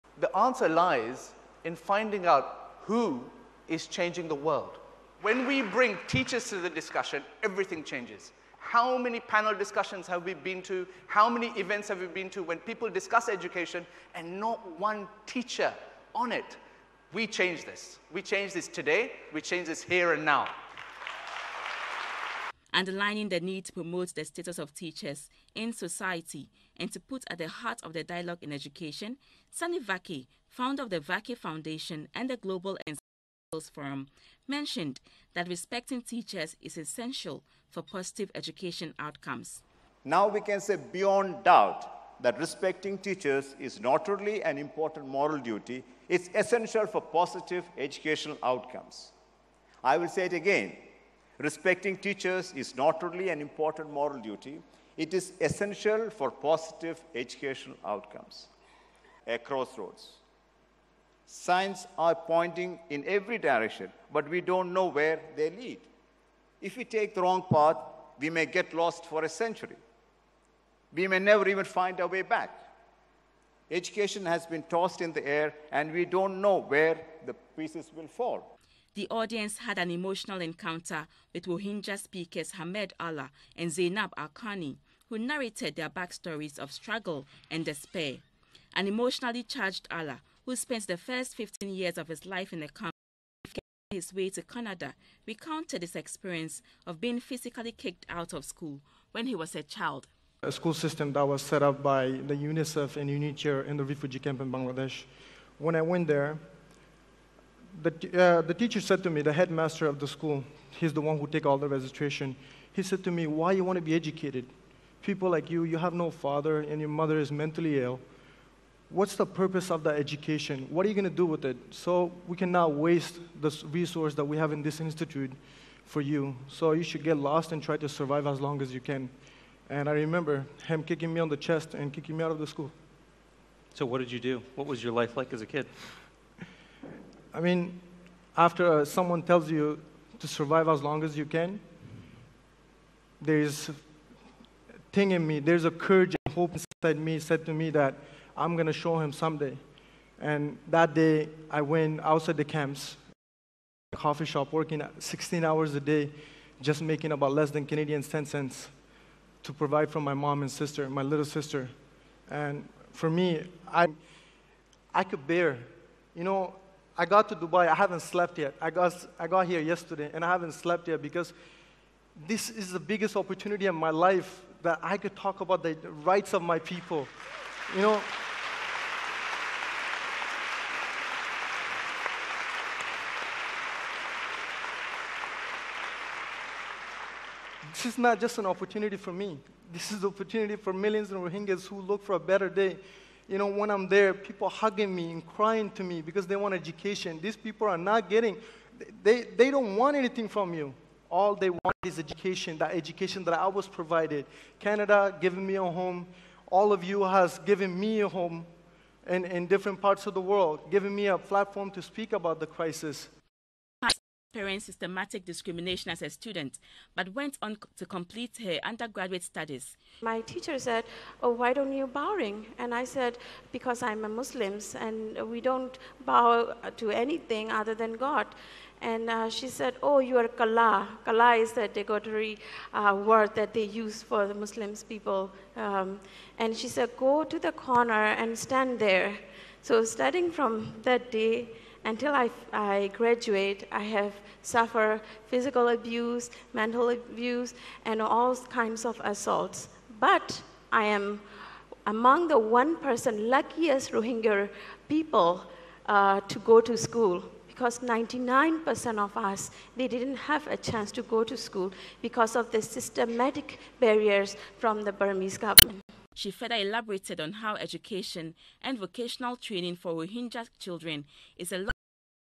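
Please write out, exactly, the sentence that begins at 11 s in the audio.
How many events have we been to when people discuss education and not one teacher on it?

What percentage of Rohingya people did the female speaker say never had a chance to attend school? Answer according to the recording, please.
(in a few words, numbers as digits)
99%.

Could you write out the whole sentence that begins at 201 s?
All they want is education, that education that I was provided.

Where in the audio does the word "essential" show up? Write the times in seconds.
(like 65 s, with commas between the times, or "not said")
36 s, 46 s, 55 s.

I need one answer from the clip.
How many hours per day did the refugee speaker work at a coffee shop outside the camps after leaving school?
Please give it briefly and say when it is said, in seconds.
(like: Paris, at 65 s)
16, at 154 s.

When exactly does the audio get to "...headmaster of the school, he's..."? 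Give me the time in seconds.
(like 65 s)
109 s.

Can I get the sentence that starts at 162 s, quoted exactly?
And for me, I, I could bear.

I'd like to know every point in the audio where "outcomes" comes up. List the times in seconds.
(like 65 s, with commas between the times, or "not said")
38 s, 48 s, 57 s.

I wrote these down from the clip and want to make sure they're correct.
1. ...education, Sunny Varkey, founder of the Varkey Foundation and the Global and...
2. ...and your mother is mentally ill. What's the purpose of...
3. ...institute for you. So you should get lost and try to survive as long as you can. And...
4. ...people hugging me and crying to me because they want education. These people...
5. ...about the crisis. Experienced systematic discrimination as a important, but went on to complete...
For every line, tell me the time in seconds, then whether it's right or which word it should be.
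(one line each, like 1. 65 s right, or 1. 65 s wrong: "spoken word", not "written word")
1. 28 s right
2. 116 s right
3. 124 s right
4. 194 s right
5. 212 s wrong: "student", not "important".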